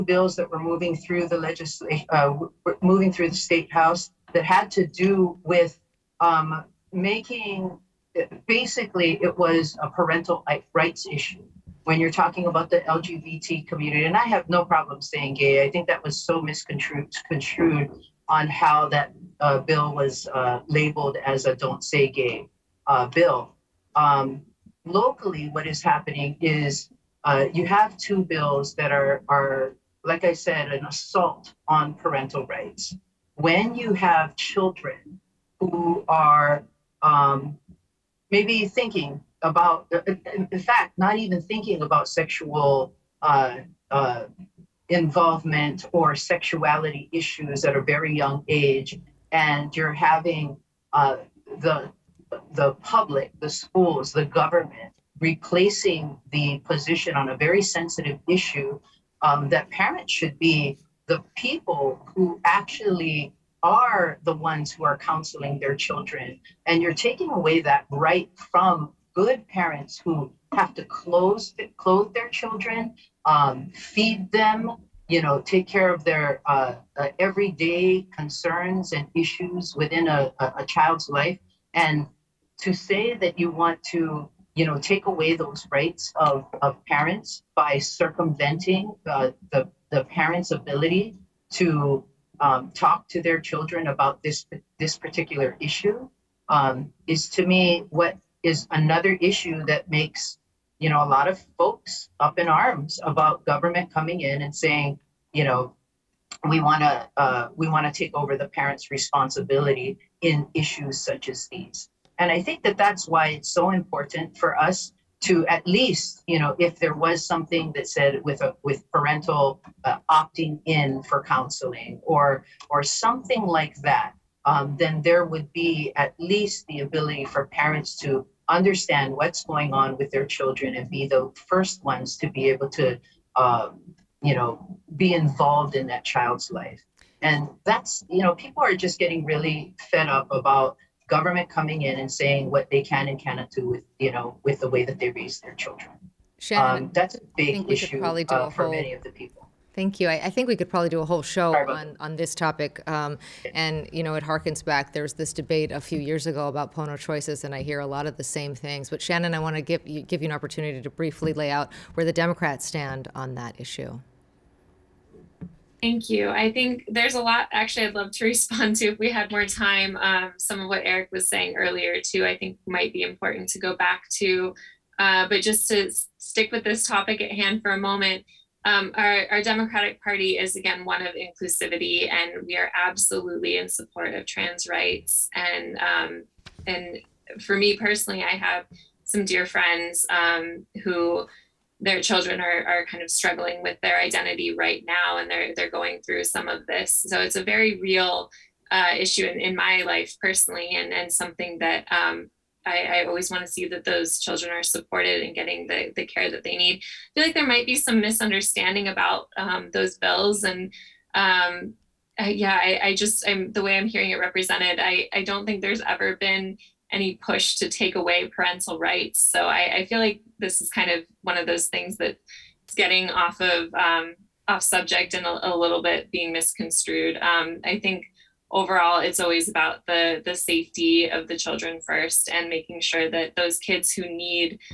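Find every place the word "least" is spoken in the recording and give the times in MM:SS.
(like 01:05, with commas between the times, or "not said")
01:55, 02:06.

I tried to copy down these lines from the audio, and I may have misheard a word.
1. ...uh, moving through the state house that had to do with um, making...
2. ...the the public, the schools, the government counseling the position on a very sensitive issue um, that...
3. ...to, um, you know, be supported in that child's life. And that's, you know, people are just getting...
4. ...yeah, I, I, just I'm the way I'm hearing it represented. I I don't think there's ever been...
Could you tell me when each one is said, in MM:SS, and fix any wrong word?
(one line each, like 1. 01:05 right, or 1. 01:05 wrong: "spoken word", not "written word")
1. 00:02 right
2. 00:51 wrong: "replacing", not "counseling"
3. 02:12 wrong: "involved", not "supported"
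4. 03:32 right.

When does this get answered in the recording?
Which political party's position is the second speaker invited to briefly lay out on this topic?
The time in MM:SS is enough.
02:42.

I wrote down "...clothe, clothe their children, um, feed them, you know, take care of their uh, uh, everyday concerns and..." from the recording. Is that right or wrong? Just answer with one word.
right.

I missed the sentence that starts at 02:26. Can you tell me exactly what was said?
Shannon, um, that's a big issue uh, whole...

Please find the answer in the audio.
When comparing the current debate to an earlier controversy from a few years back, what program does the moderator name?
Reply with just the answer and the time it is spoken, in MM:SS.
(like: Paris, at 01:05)
Pono Choices, at 02:36.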